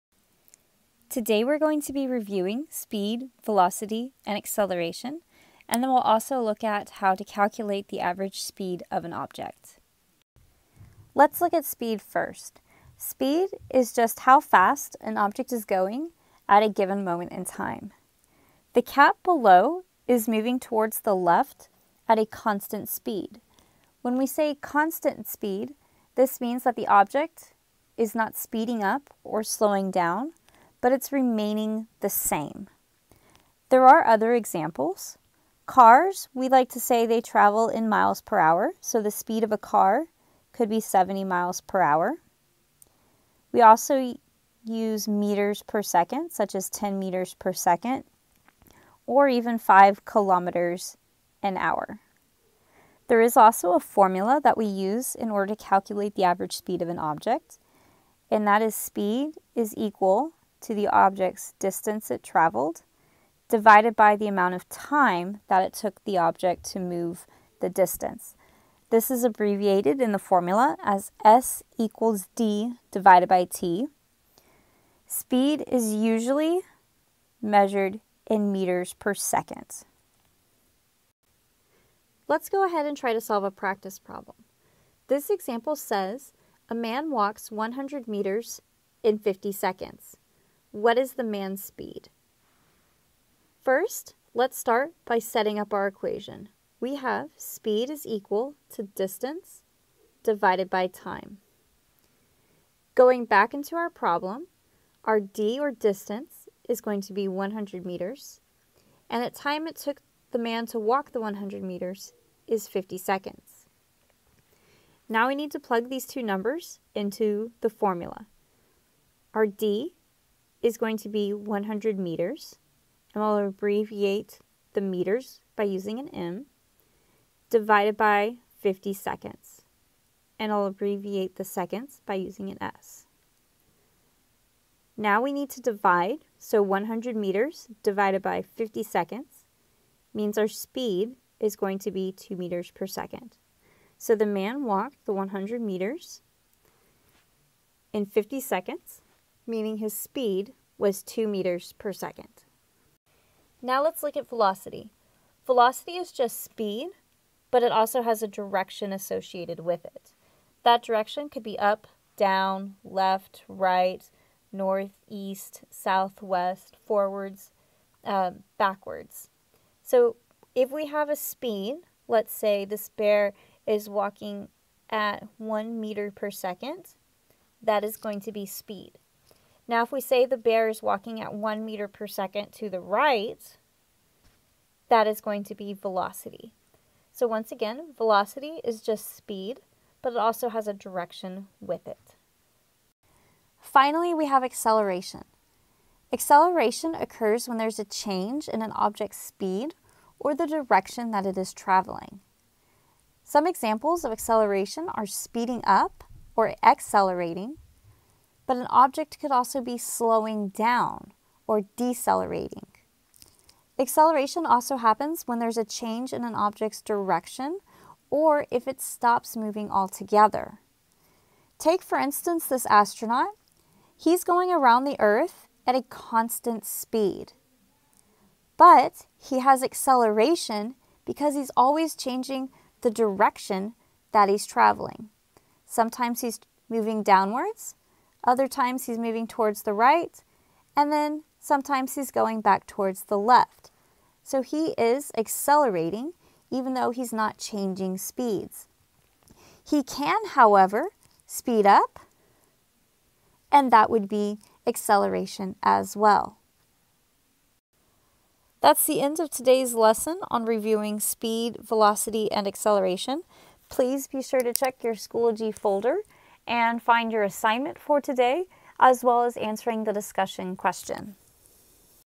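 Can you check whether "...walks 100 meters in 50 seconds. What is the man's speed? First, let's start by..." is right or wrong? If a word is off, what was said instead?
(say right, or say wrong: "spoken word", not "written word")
right.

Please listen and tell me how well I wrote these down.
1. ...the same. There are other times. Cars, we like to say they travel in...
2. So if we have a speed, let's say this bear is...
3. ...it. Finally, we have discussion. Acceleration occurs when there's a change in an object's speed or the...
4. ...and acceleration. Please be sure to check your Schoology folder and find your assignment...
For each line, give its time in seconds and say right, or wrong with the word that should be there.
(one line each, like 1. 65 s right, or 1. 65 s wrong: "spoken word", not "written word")
1. 32 s wrong: "examples", not "times"
2. 169 s right
3. 191 s wrong: "acceleration", not "discussion"
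4. 262 s right.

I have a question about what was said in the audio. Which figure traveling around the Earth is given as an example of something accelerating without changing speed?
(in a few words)
astronaut.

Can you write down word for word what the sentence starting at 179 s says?
Now, if we say the bear is walking at 1 meter per second to the right, that is going to be velocity.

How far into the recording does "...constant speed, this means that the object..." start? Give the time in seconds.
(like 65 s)
24 s.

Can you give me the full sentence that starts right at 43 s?
We also use meters per second, such as 10 meters per second, or even 5 kilometers an hour.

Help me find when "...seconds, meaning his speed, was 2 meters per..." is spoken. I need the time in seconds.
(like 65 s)
148 s.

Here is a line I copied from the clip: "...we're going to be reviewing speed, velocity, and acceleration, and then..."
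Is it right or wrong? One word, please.
right.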